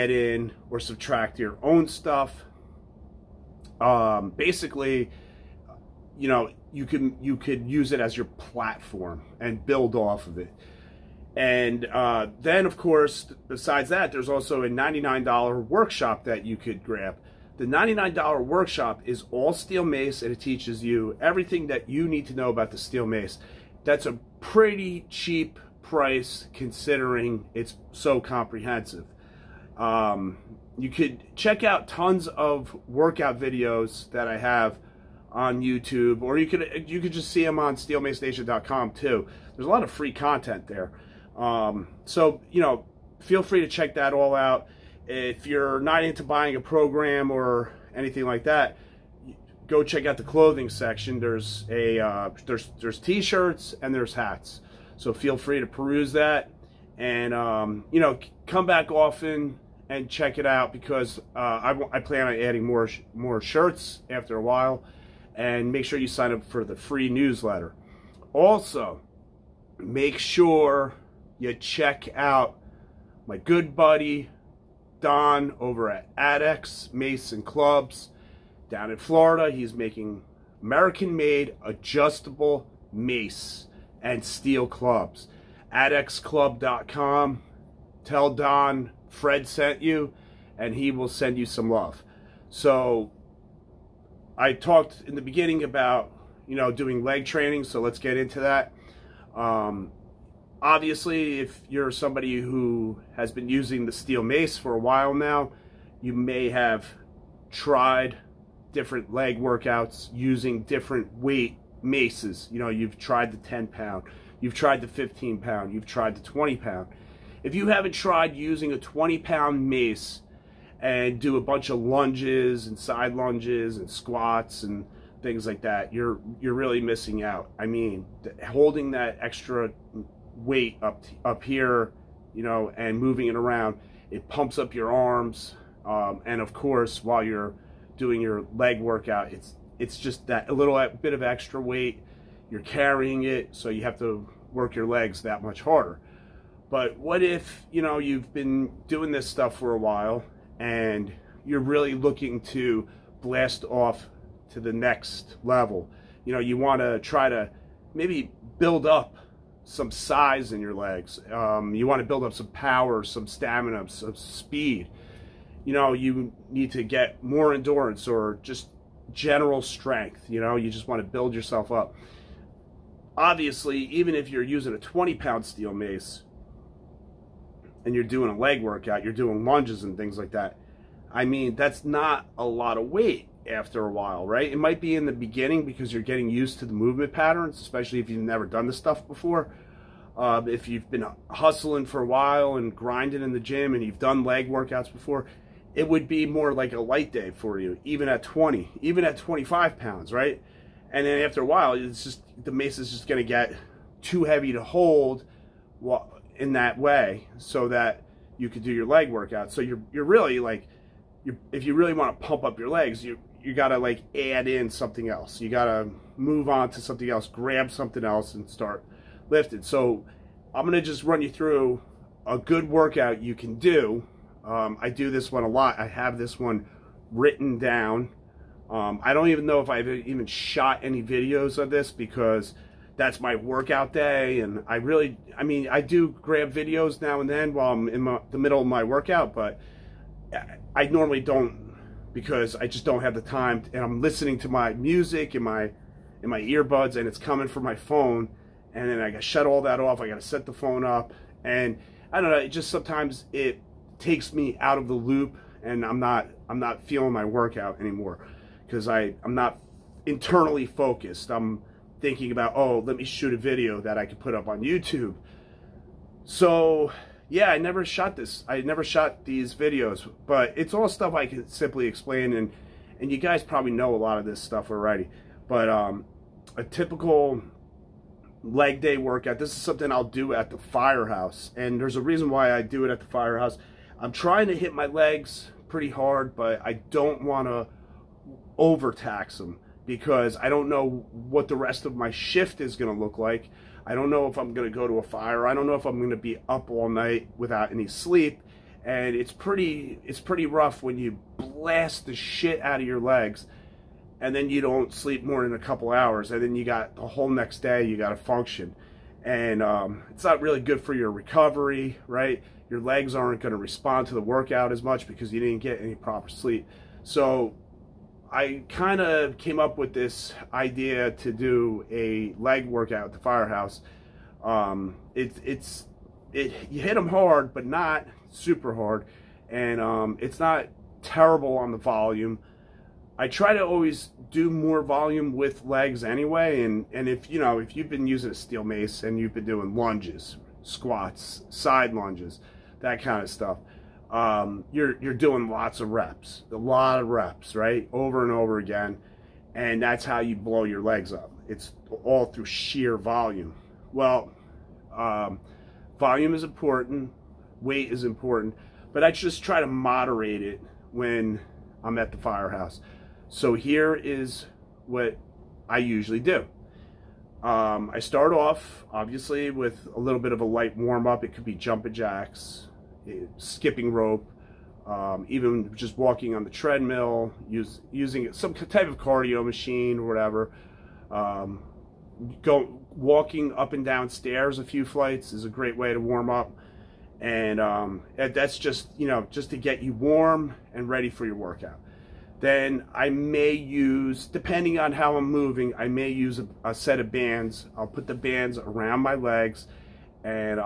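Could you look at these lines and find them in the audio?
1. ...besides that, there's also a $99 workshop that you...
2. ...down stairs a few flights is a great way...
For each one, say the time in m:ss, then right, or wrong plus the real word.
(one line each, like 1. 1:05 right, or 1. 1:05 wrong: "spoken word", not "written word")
1. 0:13 right
2. 6:23 right.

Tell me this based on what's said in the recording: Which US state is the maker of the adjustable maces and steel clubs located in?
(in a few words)
Florida.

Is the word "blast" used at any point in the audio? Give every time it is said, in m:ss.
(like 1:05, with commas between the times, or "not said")
2:33, 5:01.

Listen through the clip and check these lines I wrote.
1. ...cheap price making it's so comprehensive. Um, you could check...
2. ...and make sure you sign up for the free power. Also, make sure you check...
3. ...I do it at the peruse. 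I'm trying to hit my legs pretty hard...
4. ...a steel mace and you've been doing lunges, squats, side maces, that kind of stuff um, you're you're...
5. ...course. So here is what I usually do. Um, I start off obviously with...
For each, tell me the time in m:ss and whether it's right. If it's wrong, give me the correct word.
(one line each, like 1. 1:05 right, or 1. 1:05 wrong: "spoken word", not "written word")
1. 0:25 wrong: "considering", not "making"
2. 1:05 wrong: "newsletter", not "power"
3. 4:42 wrong: "firehouse", not "peruse"
4. 5:38 wrong: "lunges", not "maces"
5. 6:02 wrong: "firehouse", not "course".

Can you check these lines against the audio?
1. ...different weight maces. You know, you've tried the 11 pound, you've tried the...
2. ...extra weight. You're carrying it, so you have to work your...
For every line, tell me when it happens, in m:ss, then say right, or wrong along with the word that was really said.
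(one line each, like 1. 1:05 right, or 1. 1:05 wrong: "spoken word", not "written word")
1. 1:50 wrong: "10", not "11"
2. 2:21 right.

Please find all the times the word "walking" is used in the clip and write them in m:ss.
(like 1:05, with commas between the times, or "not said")
6:15, 6:22.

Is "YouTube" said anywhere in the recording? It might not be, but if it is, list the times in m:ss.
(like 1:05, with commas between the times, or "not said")
0:35, 4:24.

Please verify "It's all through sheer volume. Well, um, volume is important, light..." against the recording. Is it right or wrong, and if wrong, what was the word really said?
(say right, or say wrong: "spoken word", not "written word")
wrong: "weight", not "light".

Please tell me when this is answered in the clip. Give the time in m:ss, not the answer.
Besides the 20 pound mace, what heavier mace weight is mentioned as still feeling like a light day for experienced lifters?
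3:19.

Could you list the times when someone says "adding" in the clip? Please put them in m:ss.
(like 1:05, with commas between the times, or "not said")
1:02.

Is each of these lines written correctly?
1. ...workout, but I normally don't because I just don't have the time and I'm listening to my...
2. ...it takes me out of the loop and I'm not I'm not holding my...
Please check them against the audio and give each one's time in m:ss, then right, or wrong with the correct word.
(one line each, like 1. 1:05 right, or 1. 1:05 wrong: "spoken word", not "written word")
1. 3:58 right
2. 4:13 wrong: "feeling", not "holding".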